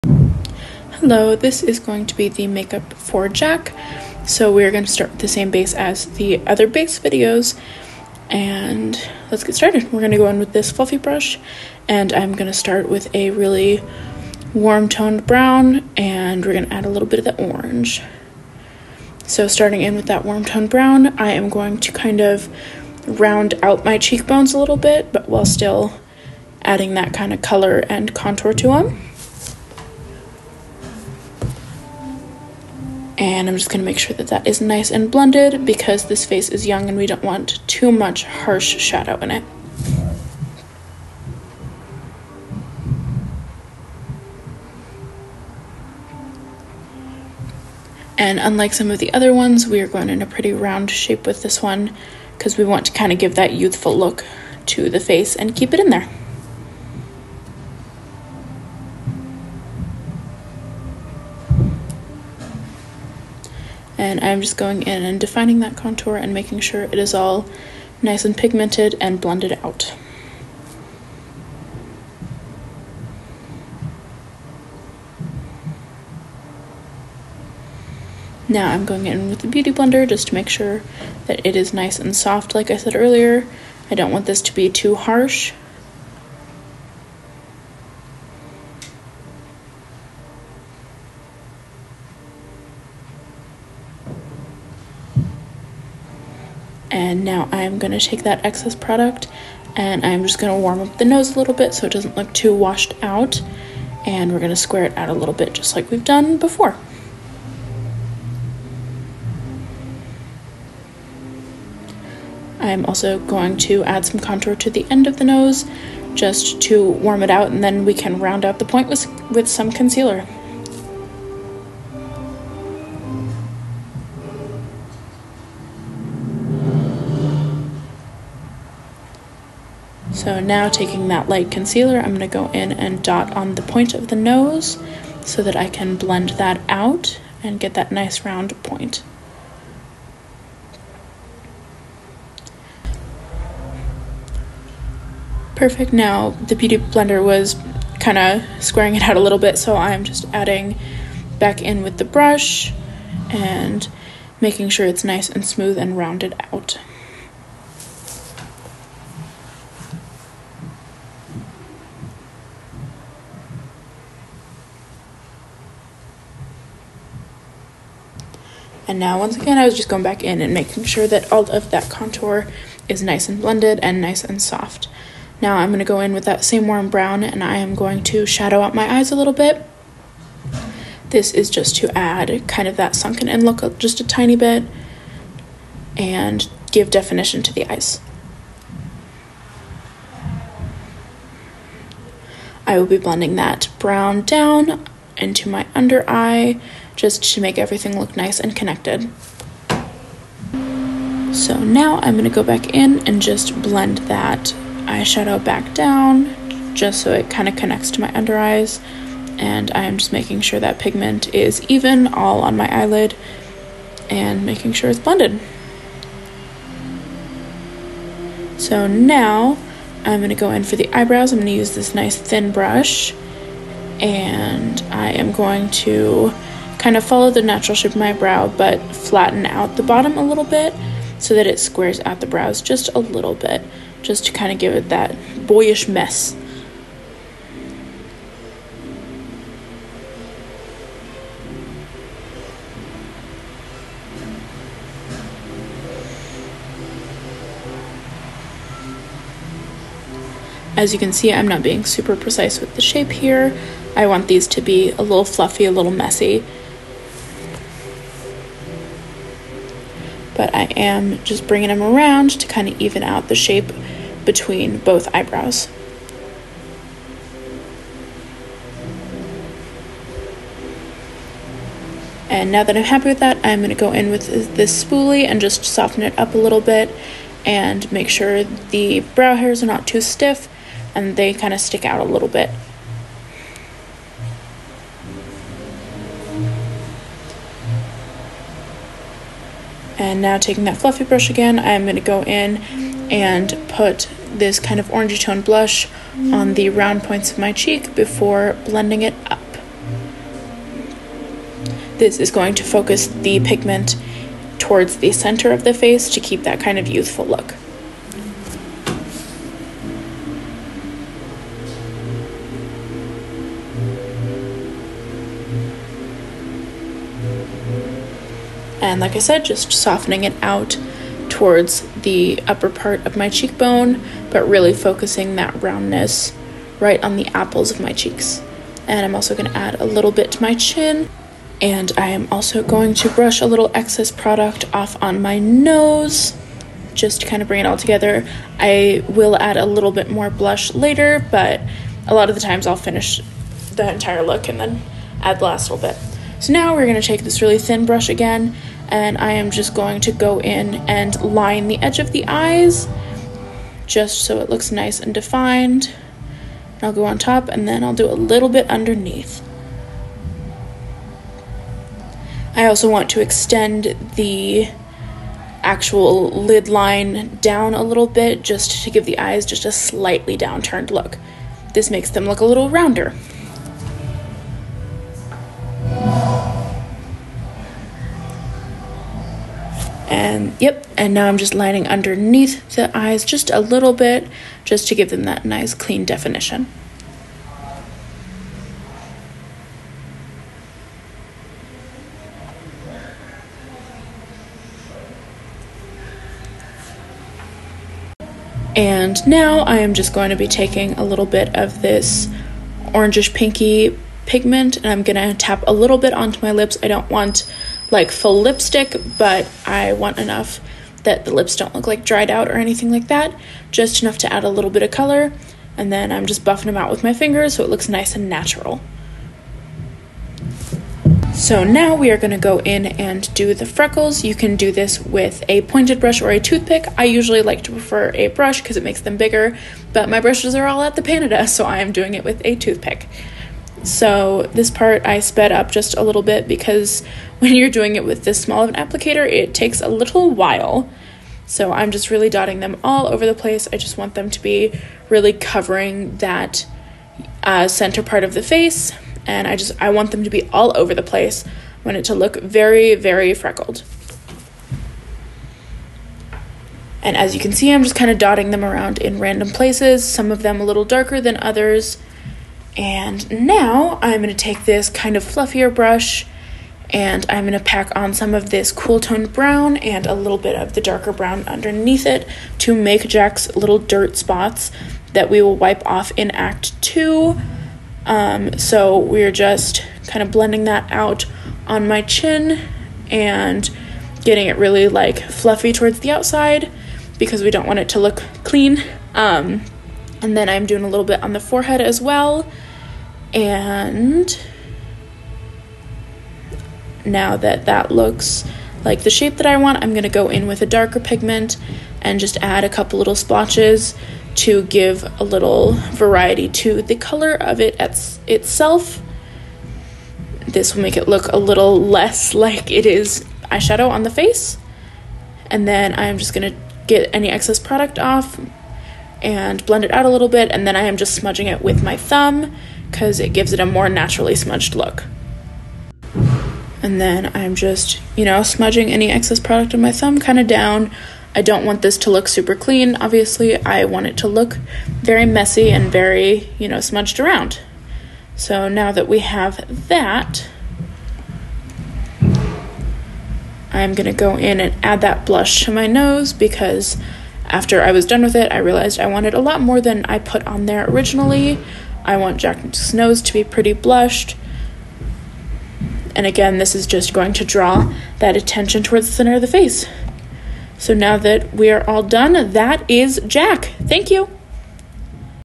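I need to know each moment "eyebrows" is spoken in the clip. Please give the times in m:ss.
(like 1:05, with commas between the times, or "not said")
3:40, 4:25.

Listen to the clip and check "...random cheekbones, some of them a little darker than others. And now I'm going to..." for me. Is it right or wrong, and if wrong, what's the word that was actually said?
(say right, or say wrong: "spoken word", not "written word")
wrong: "places", not "cheekbones".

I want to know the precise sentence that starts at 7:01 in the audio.
So now we are going to go in and do the freckles.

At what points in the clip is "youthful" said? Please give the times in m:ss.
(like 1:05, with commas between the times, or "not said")
0:53, 5:06.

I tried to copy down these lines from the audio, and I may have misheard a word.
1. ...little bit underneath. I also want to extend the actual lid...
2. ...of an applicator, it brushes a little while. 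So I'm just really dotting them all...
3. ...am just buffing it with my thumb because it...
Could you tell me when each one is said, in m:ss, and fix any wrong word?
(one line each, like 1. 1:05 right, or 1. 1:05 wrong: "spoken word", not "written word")
1. 5:58 right
2. 7:18 wrong: "takes", not "brushes"
3. 8:40 wrong: "smudging", not "buffing".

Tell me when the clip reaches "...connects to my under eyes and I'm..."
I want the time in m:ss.
3:27.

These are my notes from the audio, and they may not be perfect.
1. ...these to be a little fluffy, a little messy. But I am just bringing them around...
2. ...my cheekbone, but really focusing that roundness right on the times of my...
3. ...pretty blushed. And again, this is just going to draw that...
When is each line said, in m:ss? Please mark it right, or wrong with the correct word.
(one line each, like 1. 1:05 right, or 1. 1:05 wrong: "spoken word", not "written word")
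1. 4:14 right
2. 5:23 wrong: "apples", not "times"
3. 9:13 right.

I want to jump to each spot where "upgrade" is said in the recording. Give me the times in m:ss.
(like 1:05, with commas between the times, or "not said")
not said.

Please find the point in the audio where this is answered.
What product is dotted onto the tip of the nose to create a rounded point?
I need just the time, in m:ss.
2:11.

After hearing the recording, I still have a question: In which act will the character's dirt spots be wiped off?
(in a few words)
Act 2.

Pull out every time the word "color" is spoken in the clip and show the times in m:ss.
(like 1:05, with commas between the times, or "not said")
0:27, 6:54, 8:26.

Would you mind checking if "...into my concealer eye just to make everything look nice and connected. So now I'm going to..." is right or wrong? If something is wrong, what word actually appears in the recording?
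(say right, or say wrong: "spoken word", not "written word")
wrong: "under", not "concealer".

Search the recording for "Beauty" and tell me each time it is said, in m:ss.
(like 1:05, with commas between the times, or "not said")
1:19, 2:26.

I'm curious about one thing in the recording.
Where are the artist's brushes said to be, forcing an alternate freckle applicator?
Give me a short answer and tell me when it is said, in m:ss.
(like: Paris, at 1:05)
the Panada, at 7:10.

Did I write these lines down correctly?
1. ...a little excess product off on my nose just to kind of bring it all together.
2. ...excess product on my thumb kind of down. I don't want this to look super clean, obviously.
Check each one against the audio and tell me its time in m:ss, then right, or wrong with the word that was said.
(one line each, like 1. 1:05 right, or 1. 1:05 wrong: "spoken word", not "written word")
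1. 5:33 right
2. 8:49 right.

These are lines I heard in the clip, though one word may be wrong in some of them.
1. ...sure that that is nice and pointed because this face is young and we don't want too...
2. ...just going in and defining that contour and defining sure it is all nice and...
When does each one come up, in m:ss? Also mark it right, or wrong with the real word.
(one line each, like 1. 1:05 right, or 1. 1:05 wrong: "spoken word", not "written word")
1. 0:33 wrong: "blended", not "pointed"
2. 1:04 wrong: "making", not "defining".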